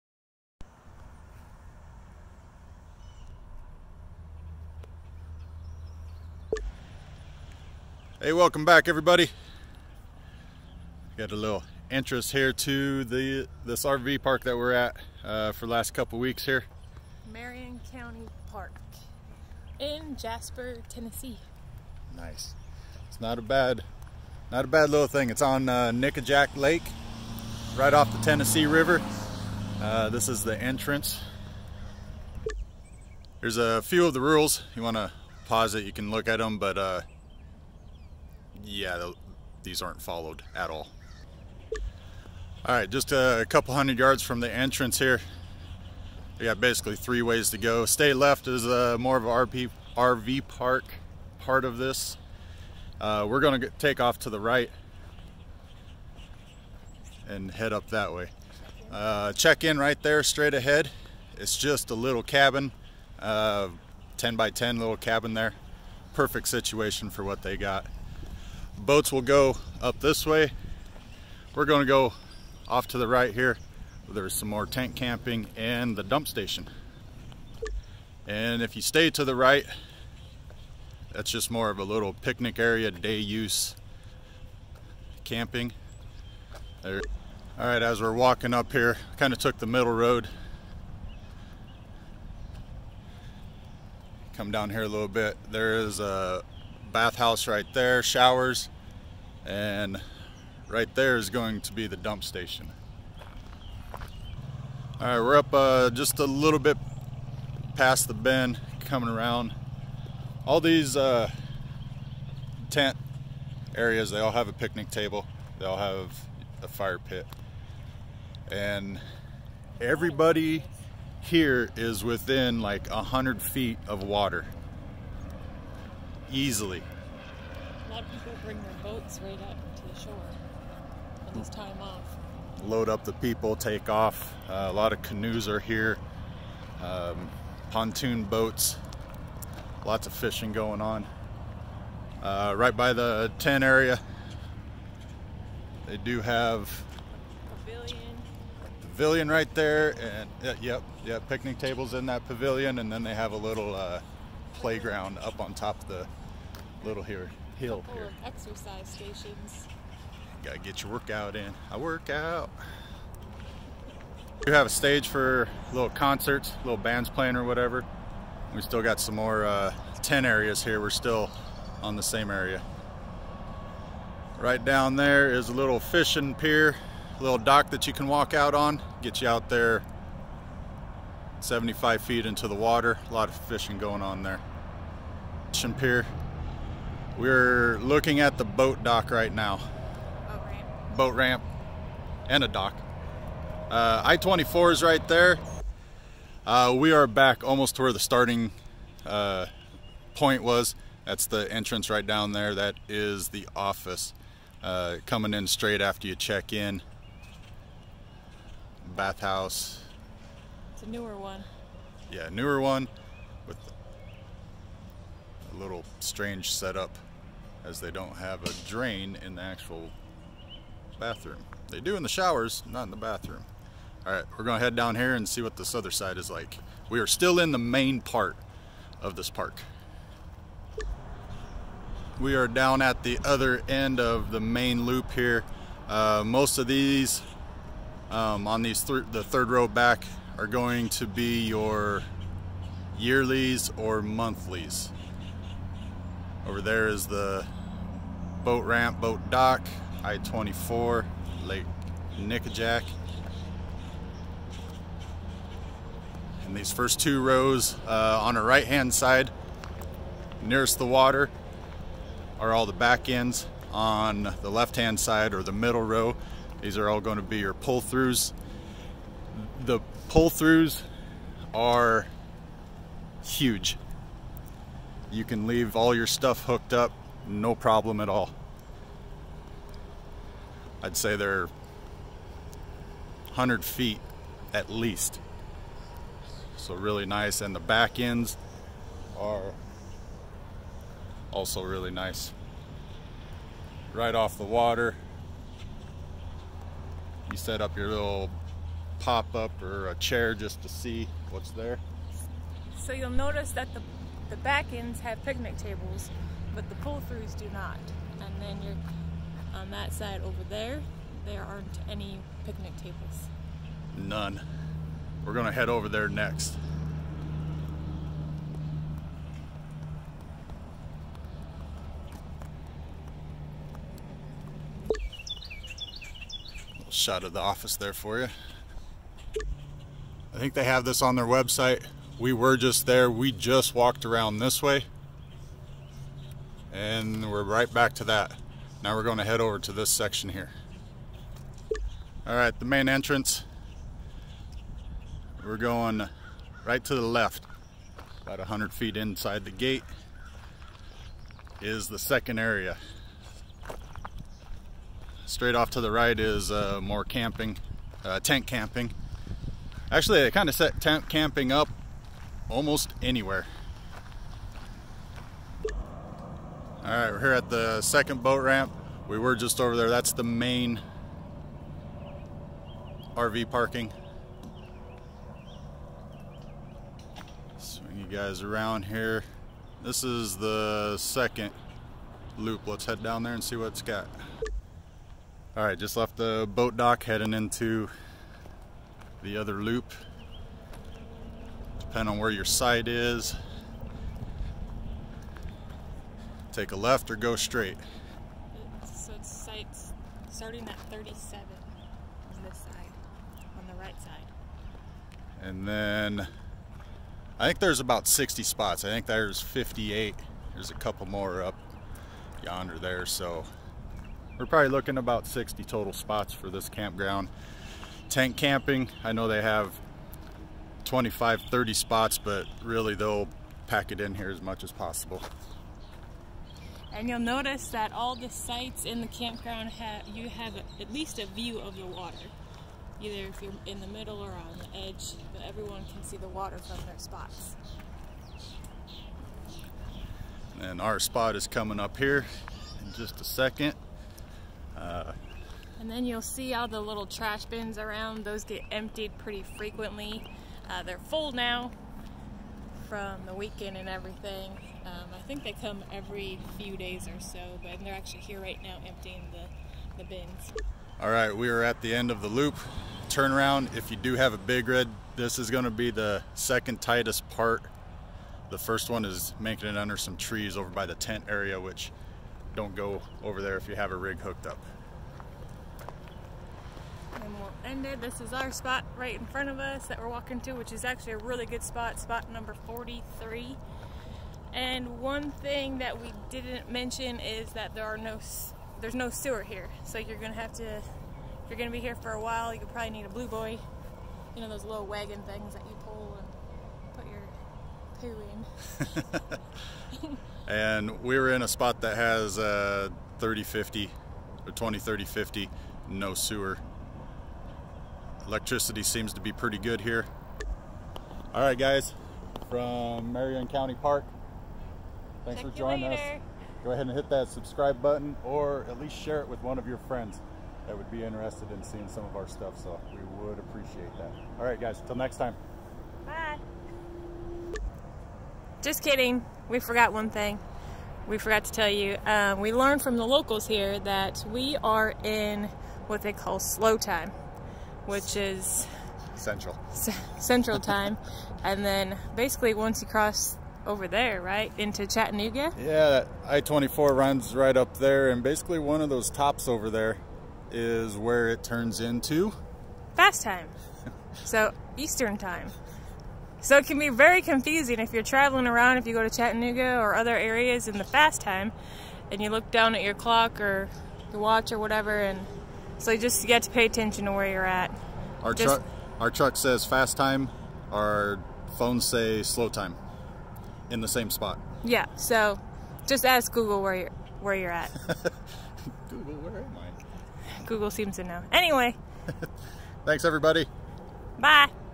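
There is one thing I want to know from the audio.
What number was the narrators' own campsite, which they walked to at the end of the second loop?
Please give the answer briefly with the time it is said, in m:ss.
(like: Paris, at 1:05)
43, at 8:02.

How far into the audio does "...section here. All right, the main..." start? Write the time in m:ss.
5:39.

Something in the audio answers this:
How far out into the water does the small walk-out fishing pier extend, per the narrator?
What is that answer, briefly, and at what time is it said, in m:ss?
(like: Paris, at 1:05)
75 feet, at 3:01.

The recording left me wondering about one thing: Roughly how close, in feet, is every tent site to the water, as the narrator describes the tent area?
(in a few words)
100 feet.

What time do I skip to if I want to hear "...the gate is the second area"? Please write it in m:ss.
5:49.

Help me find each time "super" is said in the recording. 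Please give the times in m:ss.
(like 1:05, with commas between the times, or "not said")
not said.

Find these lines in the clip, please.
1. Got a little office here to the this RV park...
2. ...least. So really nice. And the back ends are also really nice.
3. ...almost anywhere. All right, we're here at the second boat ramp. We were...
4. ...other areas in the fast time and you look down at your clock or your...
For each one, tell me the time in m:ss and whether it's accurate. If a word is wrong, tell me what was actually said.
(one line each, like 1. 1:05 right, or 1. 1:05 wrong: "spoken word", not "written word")
1. 0:11 wrong: "entrance", not "office"
2. 4:44 right
3. 6:02 right
4. 9:19 right.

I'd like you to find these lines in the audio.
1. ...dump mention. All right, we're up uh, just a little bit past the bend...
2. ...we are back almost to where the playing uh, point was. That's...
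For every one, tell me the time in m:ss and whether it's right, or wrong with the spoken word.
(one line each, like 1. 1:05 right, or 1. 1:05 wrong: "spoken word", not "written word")
1. 1:41 wrong: "station", not "mention"
2. 3:16 wrong: "starting", not "playing".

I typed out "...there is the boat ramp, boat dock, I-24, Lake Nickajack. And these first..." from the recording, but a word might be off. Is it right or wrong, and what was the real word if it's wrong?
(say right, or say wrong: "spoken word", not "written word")
right.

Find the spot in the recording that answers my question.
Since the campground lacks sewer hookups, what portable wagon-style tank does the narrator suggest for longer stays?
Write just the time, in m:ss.
8:13.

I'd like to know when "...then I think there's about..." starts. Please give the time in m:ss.
6:45.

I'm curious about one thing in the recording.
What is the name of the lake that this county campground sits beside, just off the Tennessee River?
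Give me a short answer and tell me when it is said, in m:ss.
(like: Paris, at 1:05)
Nickajack Lake, at 0:25.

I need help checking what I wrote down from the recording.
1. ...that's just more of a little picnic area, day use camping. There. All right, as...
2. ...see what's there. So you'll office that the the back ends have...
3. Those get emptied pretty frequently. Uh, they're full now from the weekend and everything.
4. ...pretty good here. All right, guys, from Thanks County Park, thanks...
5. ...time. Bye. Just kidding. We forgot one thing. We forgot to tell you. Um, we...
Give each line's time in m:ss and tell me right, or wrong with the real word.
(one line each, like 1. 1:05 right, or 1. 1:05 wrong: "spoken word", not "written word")
1. 1:21 right
2. 5:00 wrong: "notice", not "office"
3. 7:28 right
4. 8:29 wrong: "Marion", not "Thanks"
5. 8:45 right.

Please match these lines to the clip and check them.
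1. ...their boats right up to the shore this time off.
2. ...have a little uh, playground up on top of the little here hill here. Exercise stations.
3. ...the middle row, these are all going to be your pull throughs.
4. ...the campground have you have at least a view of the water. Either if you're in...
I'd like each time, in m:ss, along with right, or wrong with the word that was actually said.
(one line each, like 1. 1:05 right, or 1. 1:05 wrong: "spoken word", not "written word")
1. 2:08 right
2. 2:33 right
3. 4:25 right
4. 7:08 right.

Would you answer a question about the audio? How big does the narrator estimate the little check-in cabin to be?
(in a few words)
10 by 10.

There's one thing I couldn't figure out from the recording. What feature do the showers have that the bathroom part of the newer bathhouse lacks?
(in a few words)
A drain.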